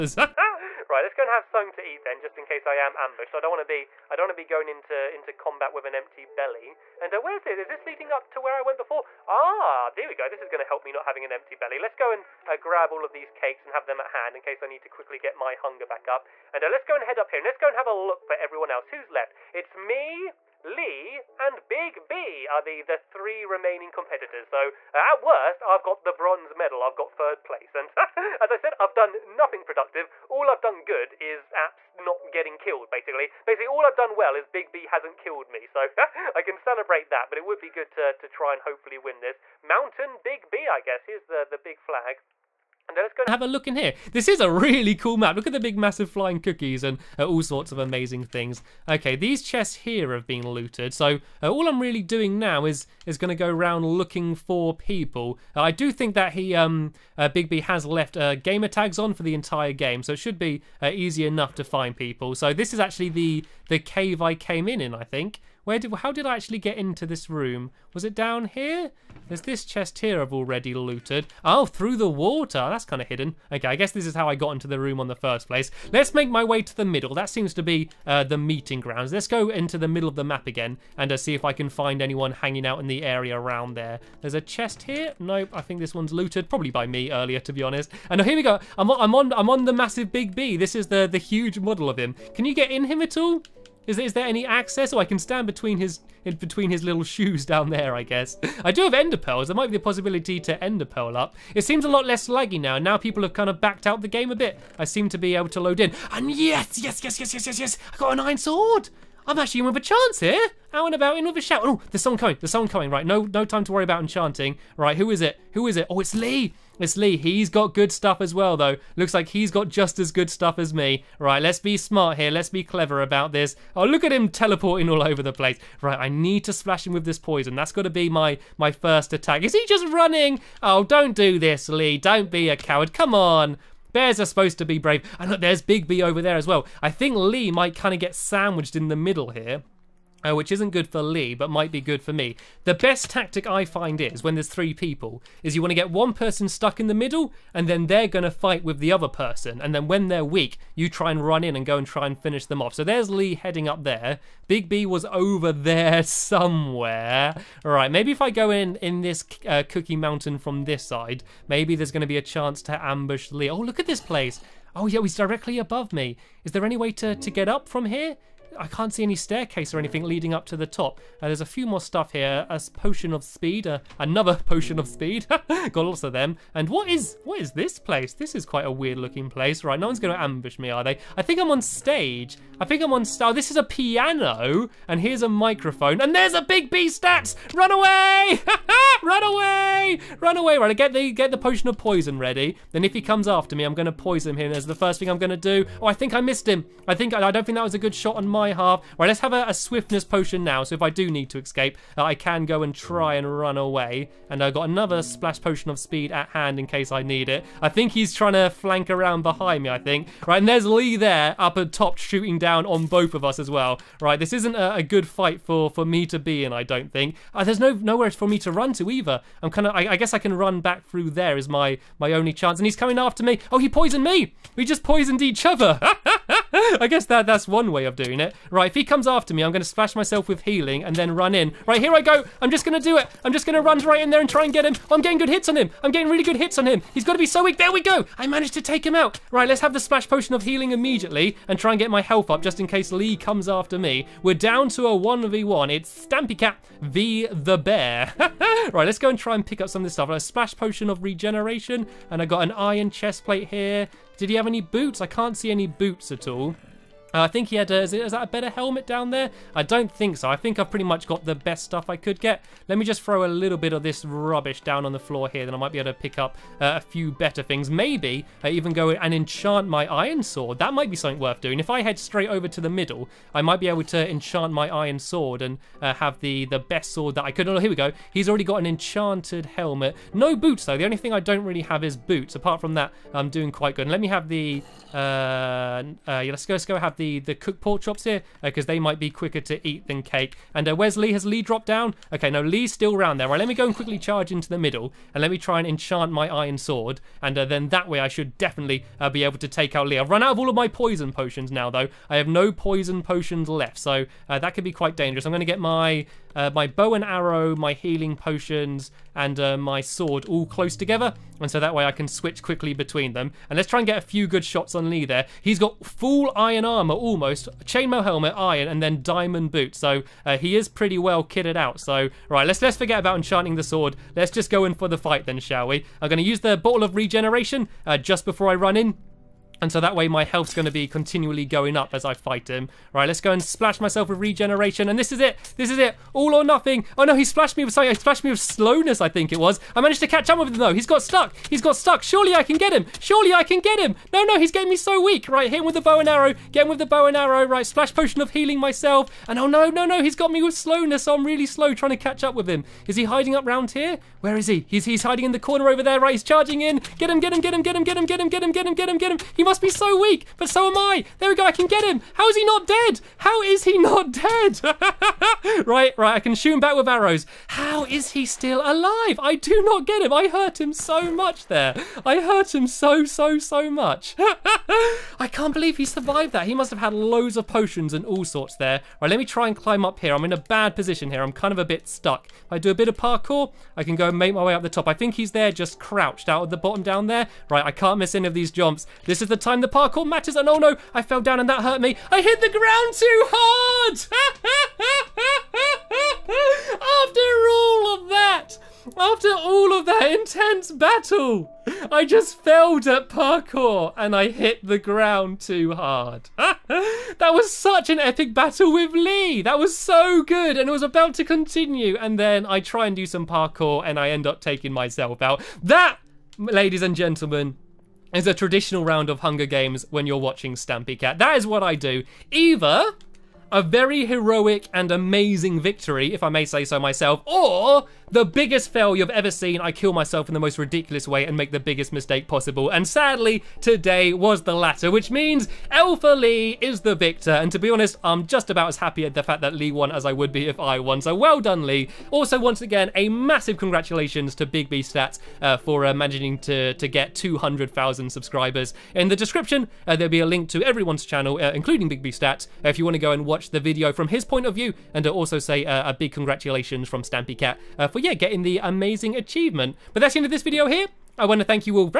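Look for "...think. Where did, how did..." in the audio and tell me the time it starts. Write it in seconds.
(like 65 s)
65 s.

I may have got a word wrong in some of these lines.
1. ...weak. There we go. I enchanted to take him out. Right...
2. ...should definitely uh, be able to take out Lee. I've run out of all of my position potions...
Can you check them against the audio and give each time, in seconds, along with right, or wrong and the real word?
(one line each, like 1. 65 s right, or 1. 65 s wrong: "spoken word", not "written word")
1. 237 s wrong: "managed", not "enchanted"
2. 298 s wrong: "poison", not "position".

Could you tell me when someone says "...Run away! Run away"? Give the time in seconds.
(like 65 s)
189 s.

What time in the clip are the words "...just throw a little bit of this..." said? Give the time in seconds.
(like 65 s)
262 s.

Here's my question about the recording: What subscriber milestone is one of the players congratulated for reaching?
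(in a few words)
200,000.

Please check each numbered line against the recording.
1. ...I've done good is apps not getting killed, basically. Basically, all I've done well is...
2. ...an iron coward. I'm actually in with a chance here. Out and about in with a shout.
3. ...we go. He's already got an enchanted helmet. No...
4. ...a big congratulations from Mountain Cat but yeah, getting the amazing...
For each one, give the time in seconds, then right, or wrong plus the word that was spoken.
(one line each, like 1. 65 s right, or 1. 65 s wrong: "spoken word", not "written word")
1. 30 s right
2. 108 s wrong: "sword", not "coward"
3. 277 s right
4. 455 s wrong: "Stampy", not "Mountain".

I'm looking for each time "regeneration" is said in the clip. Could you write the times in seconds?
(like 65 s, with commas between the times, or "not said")
251 s, 326 s, 334 s.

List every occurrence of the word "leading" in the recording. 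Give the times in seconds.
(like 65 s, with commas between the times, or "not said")
7 s, 170 s.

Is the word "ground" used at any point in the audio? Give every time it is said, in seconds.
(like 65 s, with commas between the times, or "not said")
78 s, 392 s, 404 s.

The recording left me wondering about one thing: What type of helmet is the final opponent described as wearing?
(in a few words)
chainmail helmet.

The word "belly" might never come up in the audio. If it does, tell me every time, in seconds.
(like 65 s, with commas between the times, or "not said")
6 s, 11 s.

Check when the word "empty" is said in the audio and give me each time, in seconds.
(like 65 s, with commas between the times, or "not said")
5 s, 11 s.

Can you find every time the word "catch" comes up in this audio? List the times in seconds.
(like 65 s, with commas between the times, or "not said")
340 s, 351 s.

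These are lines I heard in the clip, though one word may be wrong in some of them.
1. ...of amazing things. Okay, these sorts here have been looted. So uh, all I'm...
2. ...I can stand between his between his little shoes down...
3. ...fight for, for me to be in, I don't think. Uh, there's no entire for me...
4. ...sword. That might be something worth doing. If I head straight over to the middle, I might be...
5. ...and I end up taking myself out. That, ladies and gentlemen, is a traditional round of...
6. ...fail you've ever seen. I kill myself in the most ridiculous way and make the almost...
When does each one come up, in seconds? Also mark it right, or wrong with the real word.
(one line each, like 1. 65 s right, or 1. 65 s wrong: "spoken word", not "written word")
1. 47 s wrong: "chests", not "sorts"
2. 94 s right
3. 215 s wrong: "nowhere", not "entire"
4. 270 s right
5. 413 s right
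6. 428 s wrong: "biggest", not "almost".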